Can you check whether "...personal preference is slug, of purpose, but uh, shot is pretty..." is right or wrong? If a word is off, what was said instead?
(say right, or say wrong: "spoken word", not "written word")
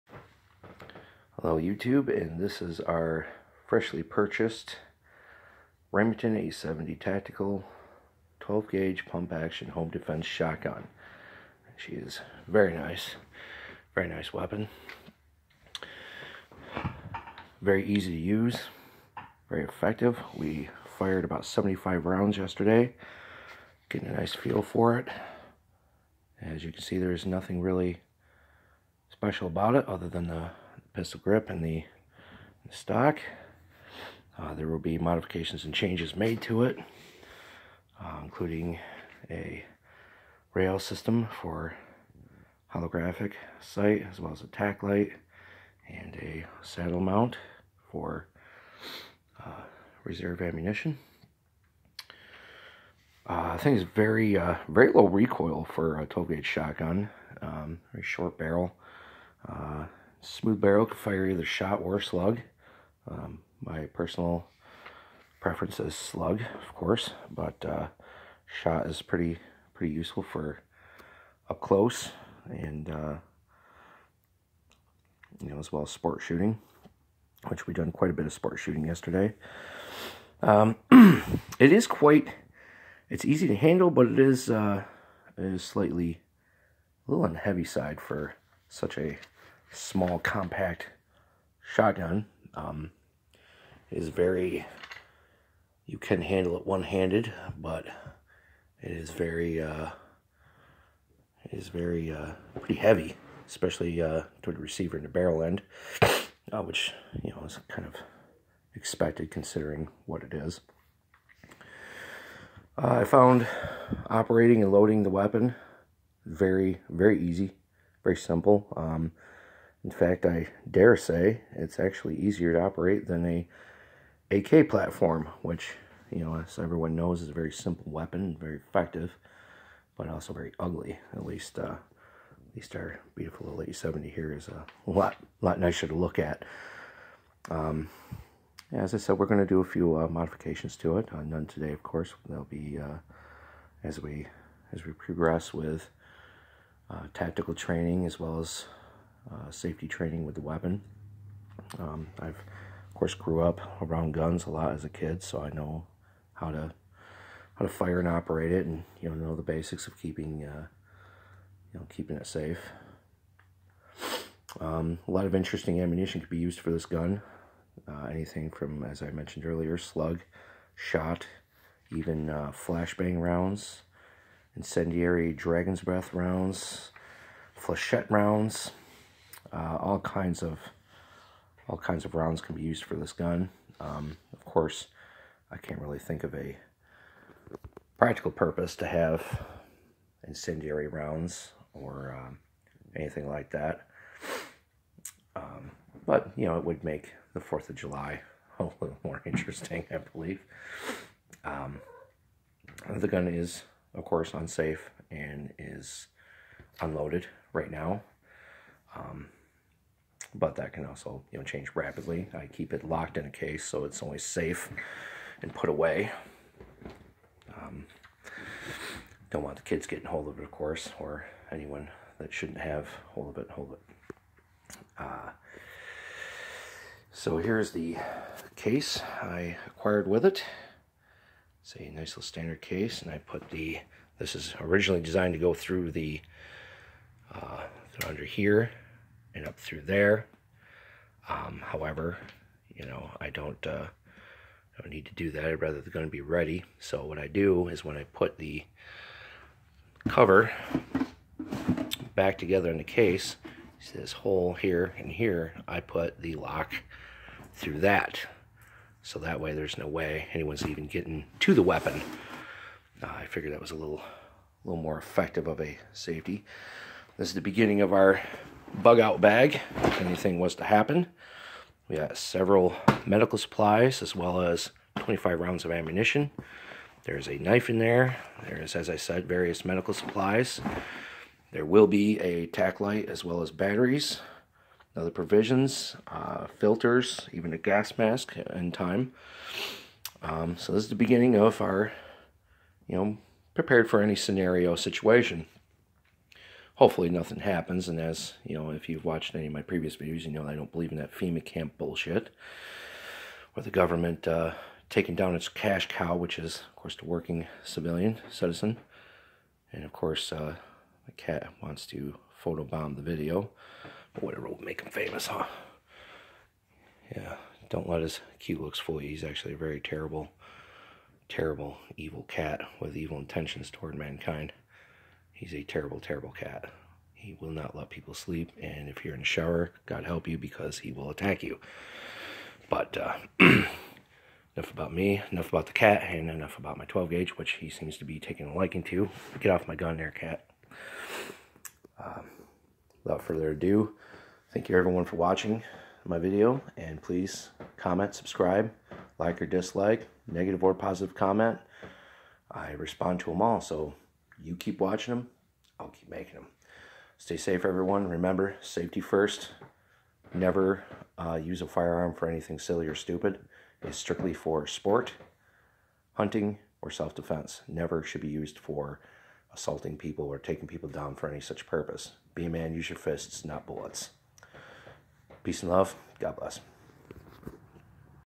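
wrong: "course", not "purpose".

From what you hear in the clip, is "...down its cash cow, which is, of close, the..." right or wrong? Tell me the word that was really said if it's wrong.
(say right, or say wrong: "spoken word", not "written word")
wrong: "course", not "close".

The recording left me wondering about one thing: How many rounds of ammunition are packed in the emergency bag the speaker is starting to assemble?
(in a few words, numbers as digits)
25.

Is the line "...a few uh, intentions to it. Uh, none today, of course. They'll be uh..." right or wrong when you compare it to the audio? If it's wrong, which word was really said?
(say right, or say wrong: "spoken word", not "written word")
wrong: "modifications", not "intentions".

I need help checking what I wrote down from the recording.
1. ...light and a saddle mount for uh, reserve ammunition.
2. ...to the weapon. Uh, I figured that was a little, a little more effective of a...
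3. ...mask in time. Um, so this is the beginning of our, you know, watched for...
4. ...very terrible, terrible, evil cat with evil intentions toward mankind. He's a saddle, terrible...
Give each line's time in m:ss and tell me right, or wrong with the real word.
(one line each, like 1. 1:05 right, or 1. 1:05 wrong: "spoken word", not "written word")
1. 0:44 right
2. 4:21 right
3. 4:47 wrong: "prepared", not "watched"
4. 5:19 wrong: "terrible", not "saddle".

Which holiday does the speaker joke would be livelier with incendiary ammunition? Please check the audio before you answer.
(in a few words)
4th of July.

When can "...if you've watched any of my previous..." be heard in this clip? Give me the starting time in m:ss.
4:58.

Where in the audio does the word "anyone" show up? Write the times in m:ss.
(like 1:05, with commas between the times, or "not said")
3:41, 4:20.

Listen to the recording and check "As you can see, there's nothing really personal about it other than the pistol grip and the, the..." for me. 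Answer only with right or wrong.
wrong.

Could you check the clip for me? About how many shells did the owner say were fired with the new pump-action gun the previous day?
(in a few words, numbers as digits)
75.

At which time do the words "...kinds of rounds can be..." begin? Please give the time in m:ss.
3:01.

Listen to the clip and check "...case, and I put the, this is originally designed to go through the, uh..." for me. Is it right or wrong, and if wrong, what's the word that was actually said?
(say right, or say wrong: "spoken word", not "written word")
right.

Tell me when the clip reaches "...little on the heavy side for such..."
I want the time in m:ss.
1:27.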